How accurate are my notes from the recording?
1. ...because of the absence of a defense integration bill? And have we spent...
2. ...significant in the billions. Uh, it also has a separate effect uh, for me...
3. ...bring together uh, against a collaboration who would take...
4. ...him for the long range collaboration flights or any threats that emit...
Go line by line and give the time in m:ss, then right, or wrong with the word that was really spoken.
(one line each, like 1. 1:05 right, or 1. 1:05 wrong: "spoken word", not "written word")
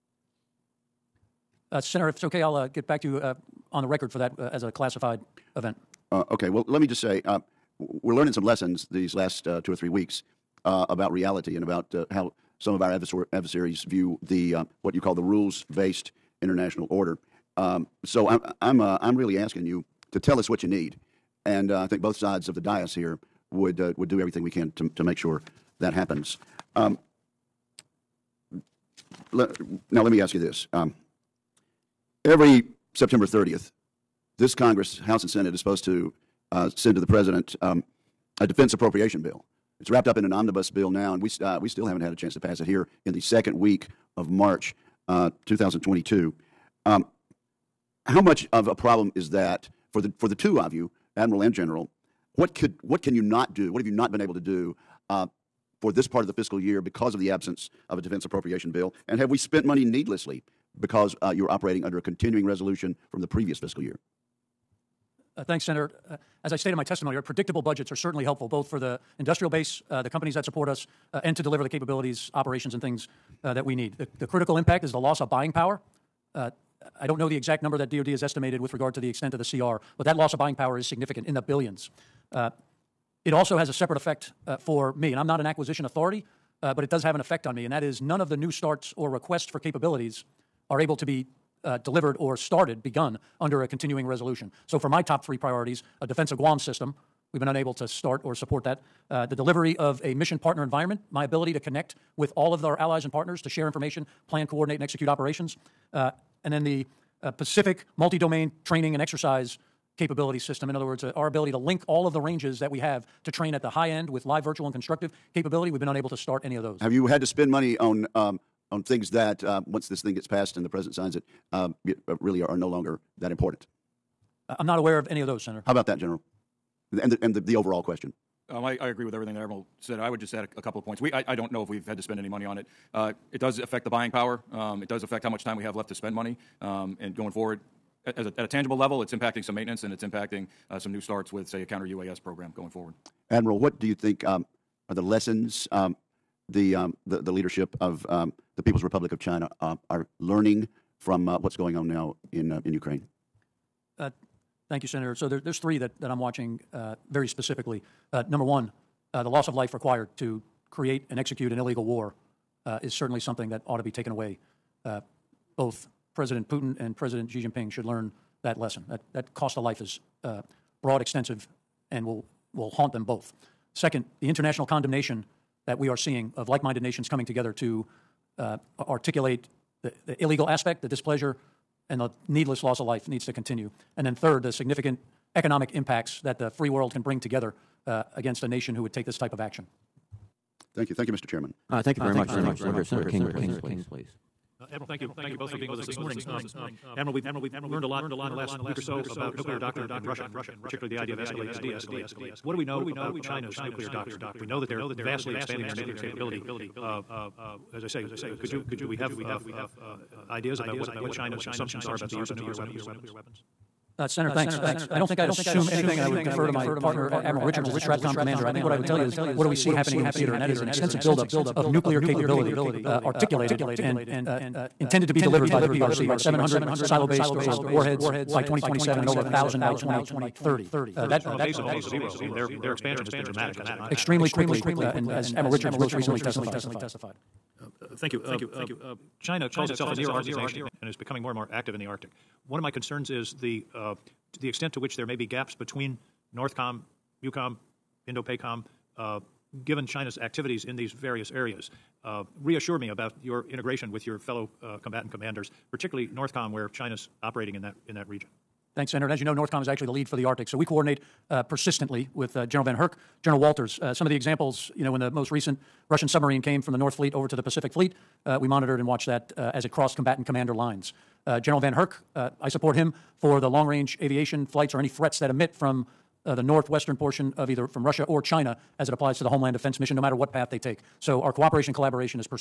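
1. 0:56 wrong: "appropriation", not "integration"
2. 1:20 right
3. 3:07 wrong: "nation", not "collaboration"
4. 4:32 wrong: "aviation", not "collaboration".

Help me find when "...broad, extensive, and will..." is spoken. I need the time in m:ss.
2:50.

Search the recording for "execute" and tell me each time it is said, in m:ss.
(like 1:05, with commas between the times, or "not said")
1:44, 2:41.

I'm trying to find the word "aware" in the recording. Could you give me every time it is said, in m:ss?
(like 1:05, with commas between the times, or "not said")
2:04.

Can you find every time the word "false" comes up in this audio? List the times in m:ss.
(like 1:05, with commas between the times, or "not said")
not said.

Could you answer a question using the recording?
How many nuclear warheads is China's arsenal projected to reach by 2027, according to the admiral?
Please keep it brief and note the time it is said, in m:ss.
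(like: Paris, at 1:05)
700, at 3:46.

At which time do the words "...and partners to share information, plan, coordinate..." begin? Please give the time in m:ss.
1:43.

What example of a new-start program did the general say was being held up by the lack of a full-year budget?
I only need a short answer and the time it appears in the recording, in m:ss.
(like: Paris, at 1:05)
counter UAS program, at 2:21.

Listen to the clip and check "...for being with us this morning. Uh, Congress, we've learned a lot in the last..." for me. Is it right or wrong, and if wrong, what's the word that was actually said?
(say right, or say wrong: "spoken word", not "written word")
wrong: "Admiral", not "Congress".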